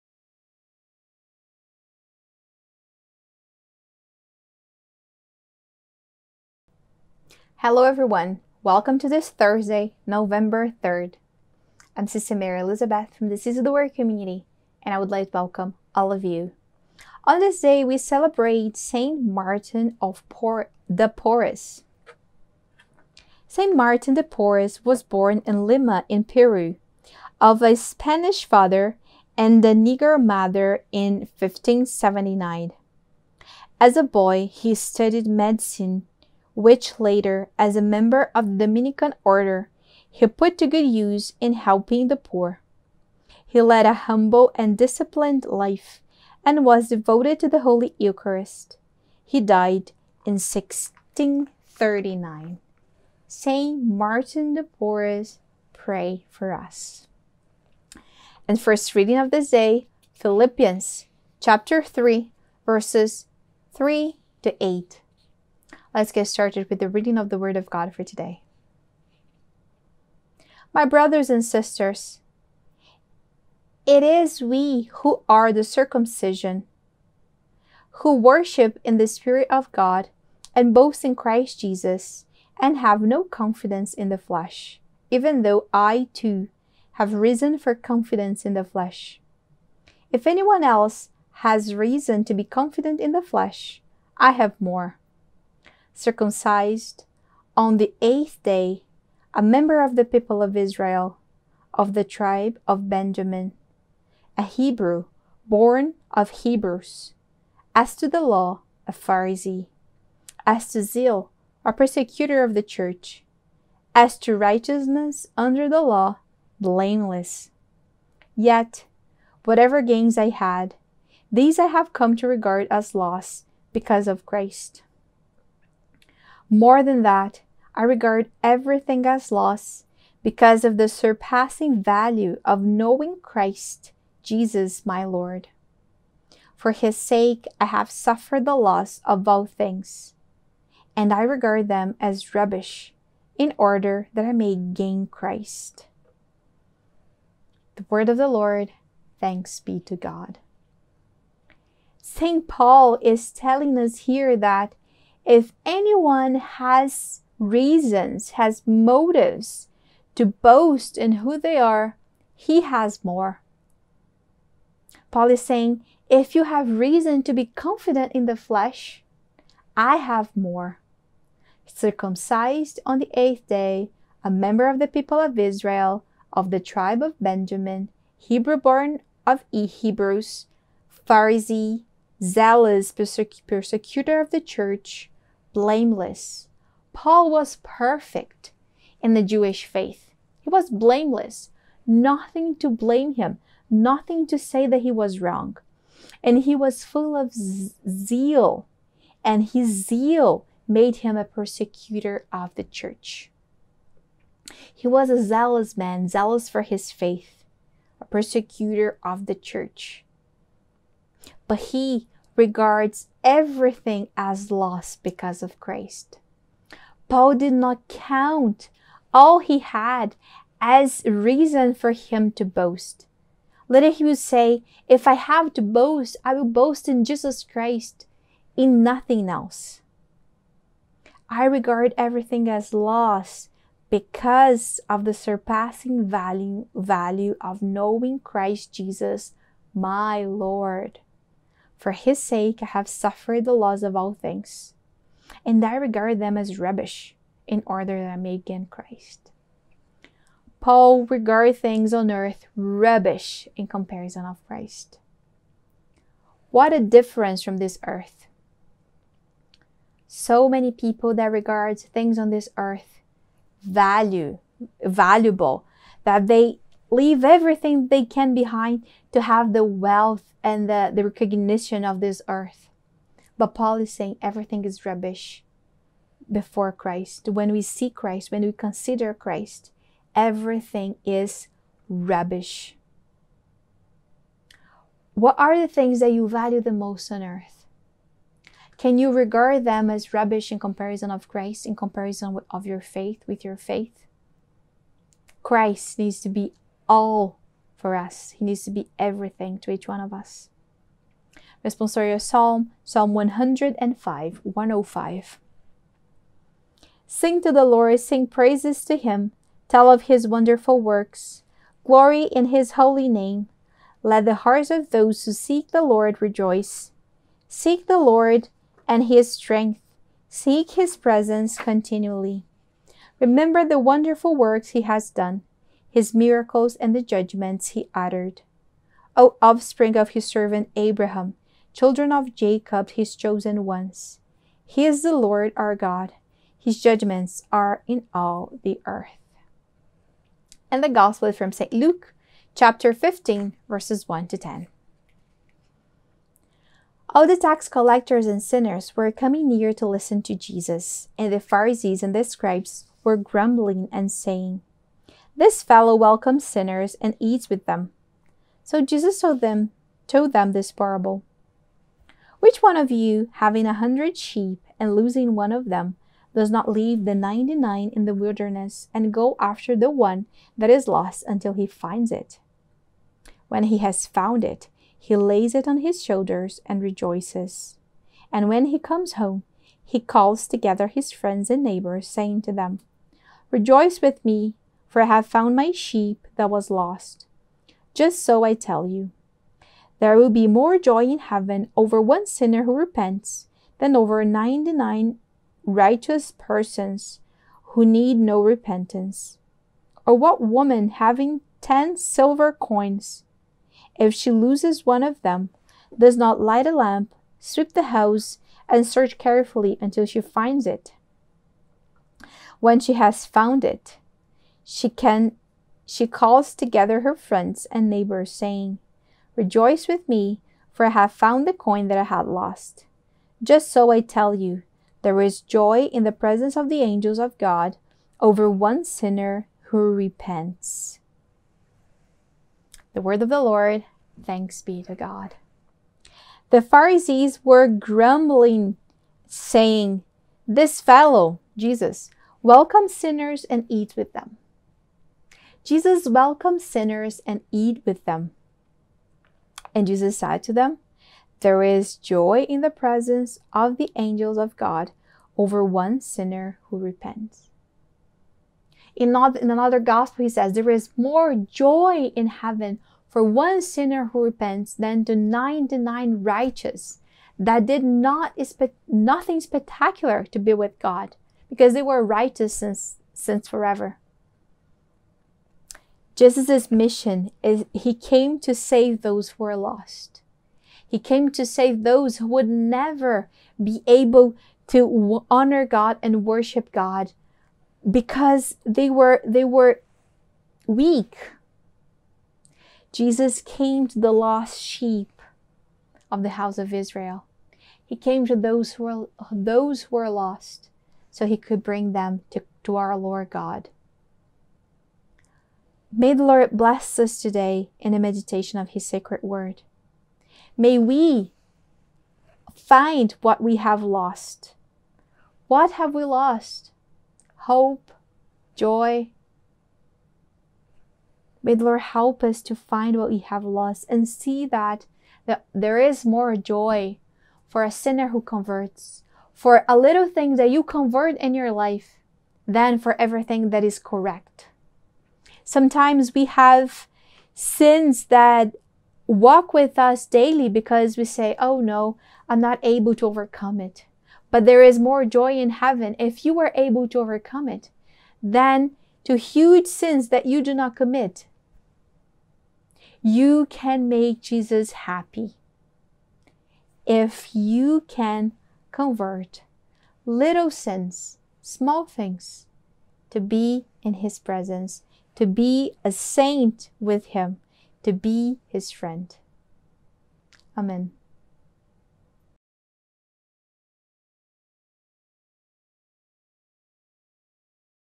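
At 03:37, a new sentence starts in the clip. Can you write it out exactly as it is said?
Paul did not count all he had as reason for him to boast.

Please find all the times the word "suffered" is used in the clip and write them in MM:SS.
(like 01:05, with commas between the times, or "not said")
02:17, 04:02.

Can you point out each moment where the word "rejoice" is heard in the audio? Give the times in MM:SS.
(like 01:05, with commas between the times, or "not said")
05:16, 06:16, 06:23, 06:59.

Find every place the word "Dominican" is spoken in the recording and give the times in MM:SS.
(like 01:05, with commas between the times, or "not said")
00:38.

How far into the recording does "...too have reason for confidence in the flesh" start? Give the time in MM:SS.
01:26.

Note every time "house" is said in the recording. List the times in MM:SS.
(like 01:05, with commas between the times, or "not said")
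06:47, 08:16.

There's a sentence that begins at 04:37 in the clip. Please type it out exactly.
When we see Christ, when we consider Christ, everything is rubbish.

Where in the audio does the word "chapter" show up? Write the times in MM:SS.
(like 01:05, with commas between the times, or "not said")
01:01, 05:42.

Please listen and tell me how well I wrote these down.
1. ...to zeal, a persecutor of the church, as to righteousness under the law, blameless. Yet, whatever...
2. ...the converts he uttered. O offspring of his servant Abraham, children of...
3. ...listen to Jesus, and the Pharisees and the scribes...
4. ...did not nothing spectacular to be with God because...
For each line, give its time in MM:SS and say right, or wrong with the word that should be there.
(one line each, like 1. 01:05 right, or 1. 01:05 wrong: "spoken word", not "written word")
1. 01:50 right
2. 05:26 wrong: "judgments", not "converts"
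3. 05:49 right
4. 07:47 right.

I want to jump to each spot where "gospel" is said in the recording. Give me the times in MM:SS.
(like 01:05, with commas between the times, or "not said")
05:40, 07:39.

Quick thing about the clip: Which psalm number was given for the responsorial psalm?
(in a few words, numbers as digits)
105.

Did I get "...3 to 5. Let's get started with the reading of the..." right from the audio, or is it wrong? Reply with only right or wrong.
wrong.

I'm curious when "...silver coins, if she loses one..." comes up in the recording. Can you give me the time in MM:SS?
06:41.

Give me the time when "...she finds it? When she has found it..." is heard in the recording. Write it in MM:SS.
06:50.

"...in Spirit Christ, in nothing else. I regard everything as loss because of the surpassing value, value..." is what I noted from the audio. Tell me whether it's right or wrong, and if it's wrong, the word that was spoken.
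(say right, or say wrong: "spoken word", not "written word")
wrong: "Jesus", not "Spirit".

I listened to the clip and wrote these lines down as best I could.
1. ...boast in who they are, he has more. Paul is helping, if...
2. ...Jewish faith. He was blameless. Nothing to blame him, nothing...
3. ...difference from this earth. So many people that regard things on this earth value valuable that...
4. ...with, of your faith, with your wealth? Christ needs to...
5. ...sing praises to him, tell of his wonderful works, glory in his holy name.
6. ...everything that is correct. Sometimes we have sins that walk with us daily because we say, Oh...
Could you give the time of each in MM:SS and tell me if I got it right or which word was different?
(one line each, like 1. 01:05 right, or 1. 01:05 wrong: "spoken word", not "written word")
1. 02:40 wrong: "saying", not "helping"
2. 03:09 right
3. 04:16 right
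4. 04:52 wrong: "faith", not "wealth"
5. 05:07 right
6. 08:52 right.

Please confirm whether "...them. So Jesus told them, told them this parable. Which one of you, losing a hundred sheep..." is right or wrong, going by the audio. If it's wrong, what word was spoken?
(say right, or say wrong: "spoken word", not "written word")
wrong: "having", not "losing".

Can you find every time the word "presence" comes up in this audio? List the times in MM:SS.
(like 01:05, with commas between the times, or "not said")
05:20, 07:06, 07:32, 09:24.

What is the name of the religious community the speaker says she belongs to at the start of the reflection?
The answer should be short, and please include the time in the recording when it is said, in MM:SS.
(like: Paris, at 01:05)
Seeds of the Word, at 00:13.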